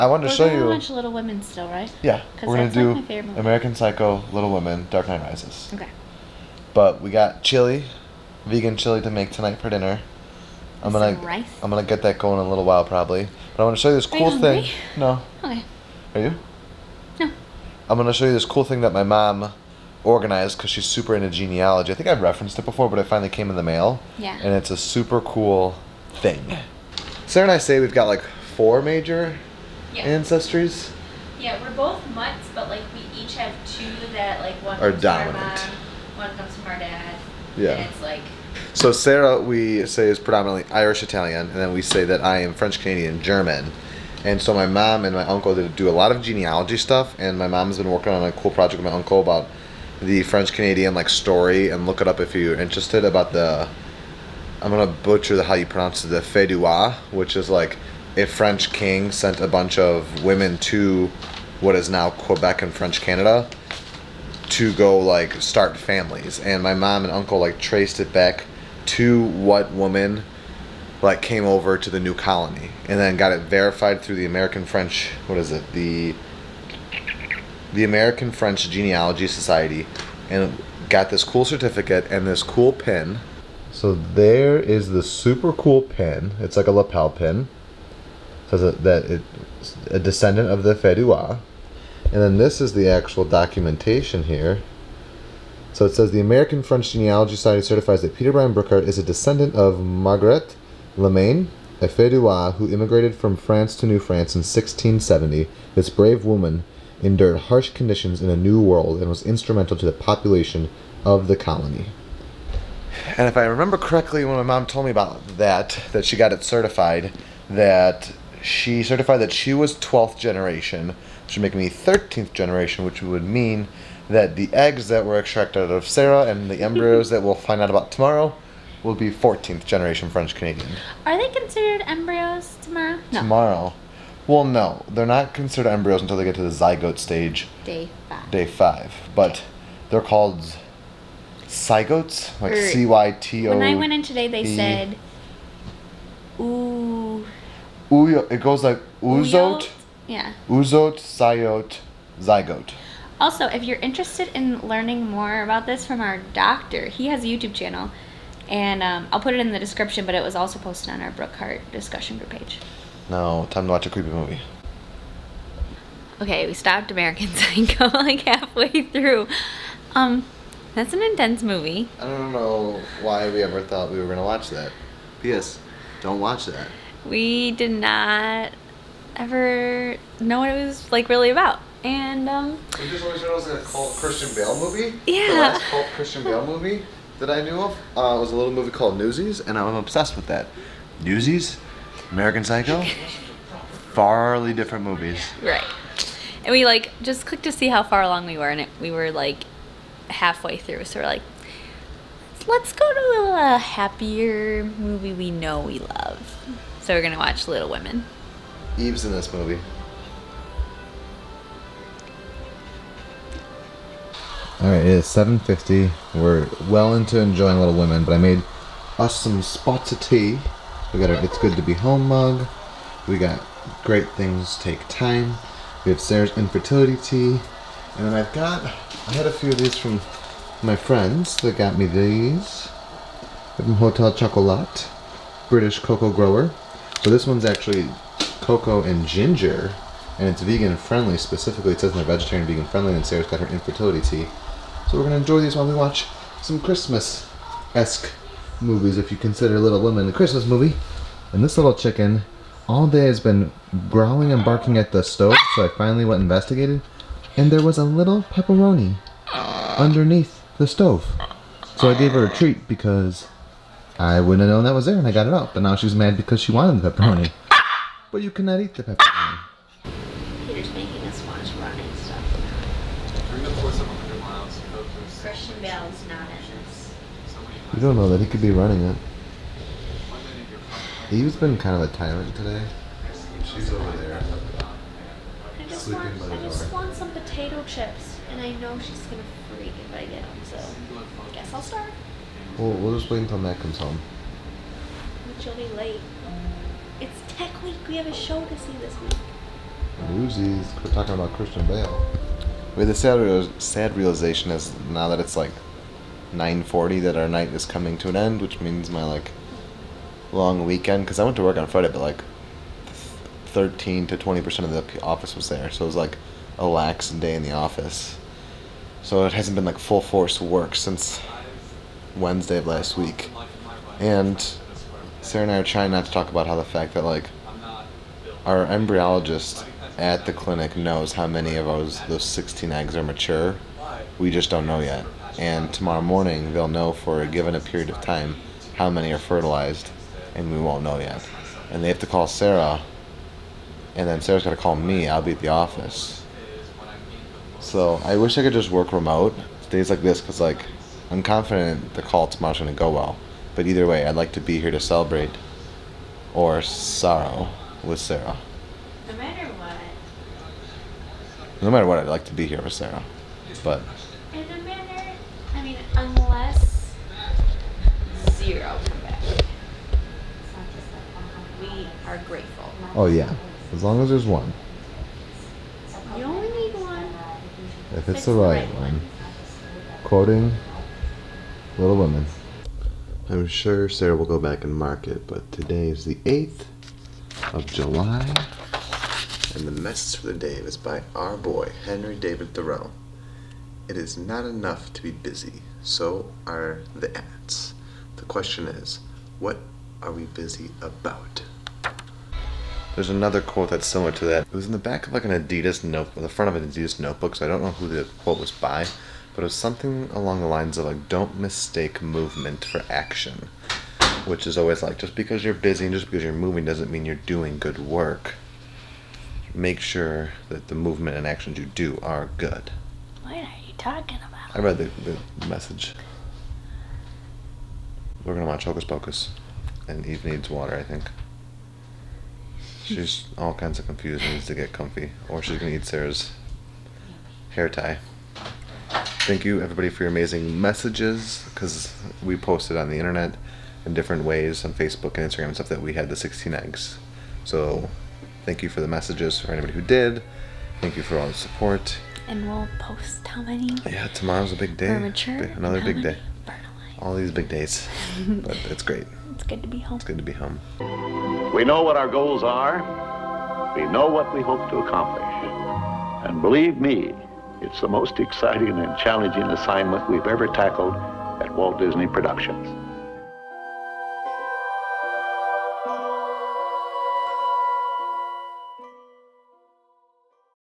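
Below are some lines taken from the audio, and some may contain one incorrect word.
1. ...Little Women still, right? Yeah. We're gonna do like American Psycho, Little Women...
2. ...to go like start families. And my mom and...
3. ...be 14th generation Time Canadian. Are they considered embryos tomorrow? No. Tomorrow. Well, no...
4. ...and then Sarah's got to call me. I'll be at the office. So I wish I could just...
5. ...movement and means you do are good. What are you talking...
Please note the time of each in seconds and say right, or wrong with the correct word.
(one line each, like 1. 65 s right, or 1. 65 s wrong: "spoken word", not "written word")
1. 0 s right
2. 64 s right
3. 128 s wrong: "French", not "Time"
4. 343 s right
5. 420 s wrong: "actions", not "means".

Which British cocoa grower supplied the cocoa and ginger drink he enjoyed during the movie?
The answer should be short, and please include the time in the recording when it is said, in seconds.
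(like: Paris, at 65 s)
Hotel Chocolat, at 233 s.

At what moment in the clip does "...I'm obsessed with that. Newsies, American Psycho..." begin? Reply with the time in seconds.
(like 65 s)
189 s.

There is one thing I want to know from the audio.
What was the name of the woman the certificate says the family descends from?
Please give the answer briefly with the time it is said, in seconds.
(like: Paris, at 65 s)
Margaret Lemaine, at 99 s.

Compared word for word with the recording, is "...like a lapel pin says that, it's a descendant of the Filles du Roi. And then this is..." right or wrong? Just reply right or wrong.
right.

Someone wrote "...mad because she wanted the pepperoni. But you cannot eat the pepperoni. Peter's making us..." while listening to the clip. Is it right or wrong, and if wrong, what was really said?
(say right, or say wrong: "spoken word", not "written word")
right.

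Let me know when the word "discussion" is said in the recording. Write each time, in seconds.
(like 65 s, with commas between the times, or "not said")
161 s.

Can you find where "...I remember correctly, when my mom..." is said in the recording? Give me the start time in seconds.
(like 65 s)
113 s.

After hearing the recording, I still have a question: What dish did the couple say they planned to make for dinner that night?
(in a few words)
Vegan chili.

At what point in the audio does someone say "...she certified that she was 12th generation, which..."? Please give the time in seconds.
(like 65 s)
118 s.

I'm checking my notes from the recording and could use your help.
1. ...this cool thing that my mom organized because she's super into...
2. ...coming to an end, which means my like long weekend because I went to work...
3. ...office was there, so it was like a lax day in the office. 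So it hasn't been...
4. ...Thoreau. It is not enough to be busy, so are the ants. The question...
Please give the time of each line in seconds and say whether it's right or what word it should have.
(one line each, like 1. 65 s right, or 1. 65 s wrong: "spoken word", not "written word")
1. 18 s right
2. 307 s right
3. 315 s right
4. 392 s right.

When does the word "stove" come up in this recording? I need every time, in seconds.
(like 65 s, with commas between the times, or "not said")
255 s, 260 s.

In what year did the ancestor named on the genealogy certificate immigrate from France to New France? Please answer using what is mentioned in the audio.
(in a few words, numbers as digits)
1670.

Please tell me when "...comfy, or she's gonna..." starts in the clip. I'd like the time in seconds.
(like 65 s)
434 s.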